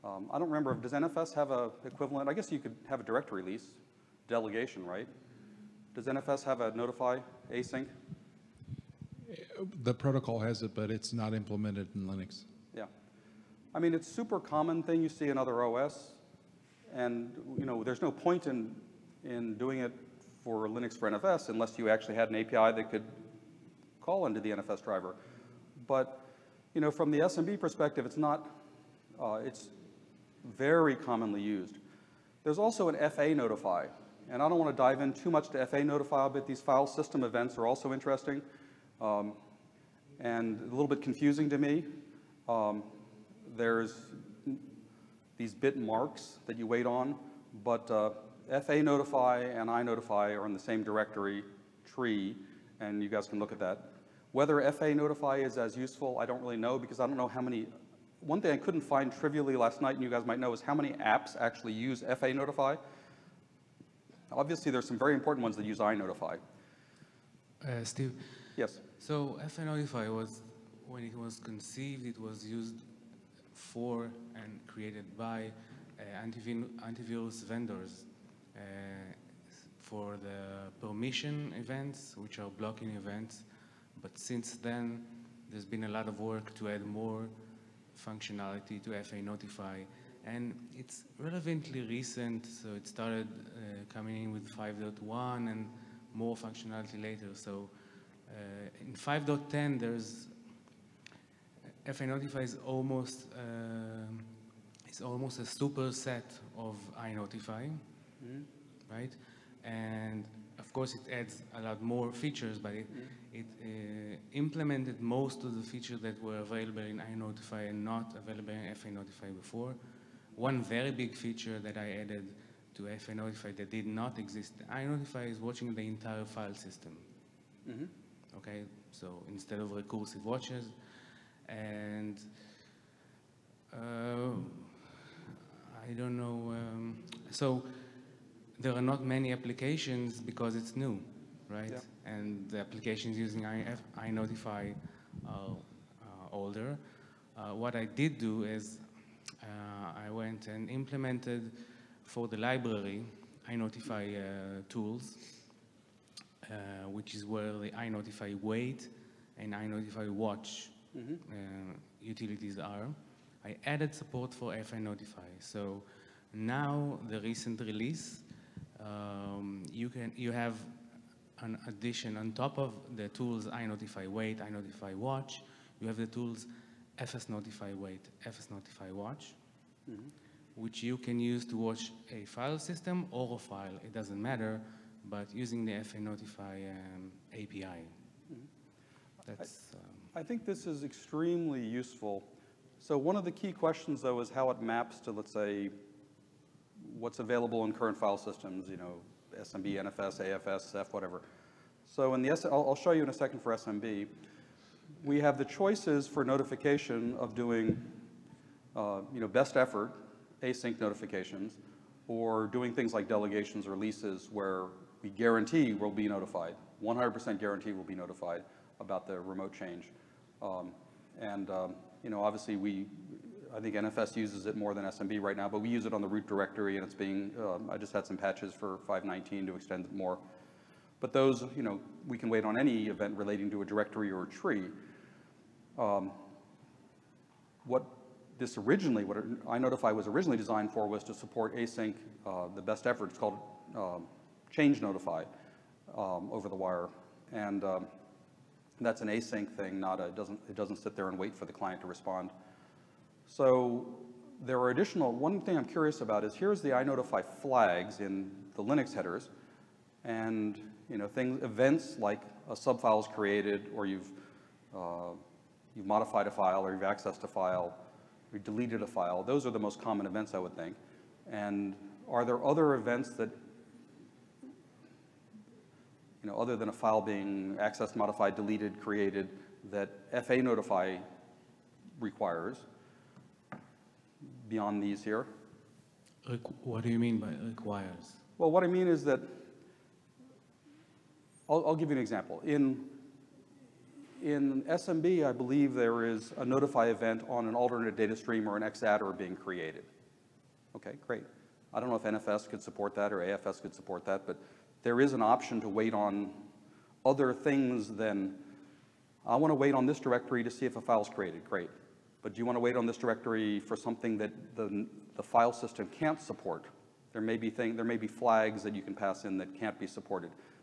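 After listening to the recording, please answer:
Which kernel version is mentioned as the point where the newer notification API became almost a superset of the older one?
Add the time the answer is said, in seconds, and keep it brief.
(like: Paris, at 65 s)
5.10, at 98 s.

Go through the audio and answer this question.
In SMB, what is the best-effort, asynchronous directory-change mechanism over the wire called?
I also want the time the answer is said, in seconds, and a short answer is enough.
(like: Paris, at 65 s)
Change notify, at 244 s.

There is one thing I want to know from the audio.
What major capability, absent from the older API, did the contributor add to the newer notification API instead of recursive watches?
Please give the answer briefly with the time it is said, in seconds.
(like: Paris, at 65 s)
Watching the entire file system, at 125 s.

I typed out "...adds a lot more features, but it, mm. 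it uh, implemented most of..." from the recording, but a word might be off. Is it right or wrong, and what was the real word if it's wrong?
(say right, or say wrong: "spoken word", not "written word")
right.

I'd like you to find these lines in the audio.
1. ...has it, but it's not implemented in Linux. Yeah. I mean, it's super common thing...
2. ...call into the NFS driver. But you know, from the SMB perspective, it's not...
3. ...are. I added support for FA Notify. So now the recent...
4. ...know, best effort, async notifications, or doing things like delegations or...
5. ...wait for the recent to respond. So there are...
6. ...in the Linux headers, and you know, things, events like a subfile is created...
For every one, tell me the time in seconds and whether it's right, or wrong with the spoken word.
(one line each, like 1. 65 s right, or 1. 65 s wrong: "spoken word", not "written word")
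1. 10 s right
2. 24 s right
3. 162 s right
4. 209 s right
5. 251 s wrong: "client", not "recent"
6. 258 s right.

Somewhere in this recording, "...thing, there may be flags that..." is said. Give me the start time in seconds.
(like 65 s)
317 s.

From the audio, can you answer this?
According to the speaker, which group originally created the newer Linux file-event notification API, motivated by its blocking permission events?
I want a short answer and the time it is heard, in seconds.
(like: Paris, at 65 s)
Antivirus vendors, at 76 s.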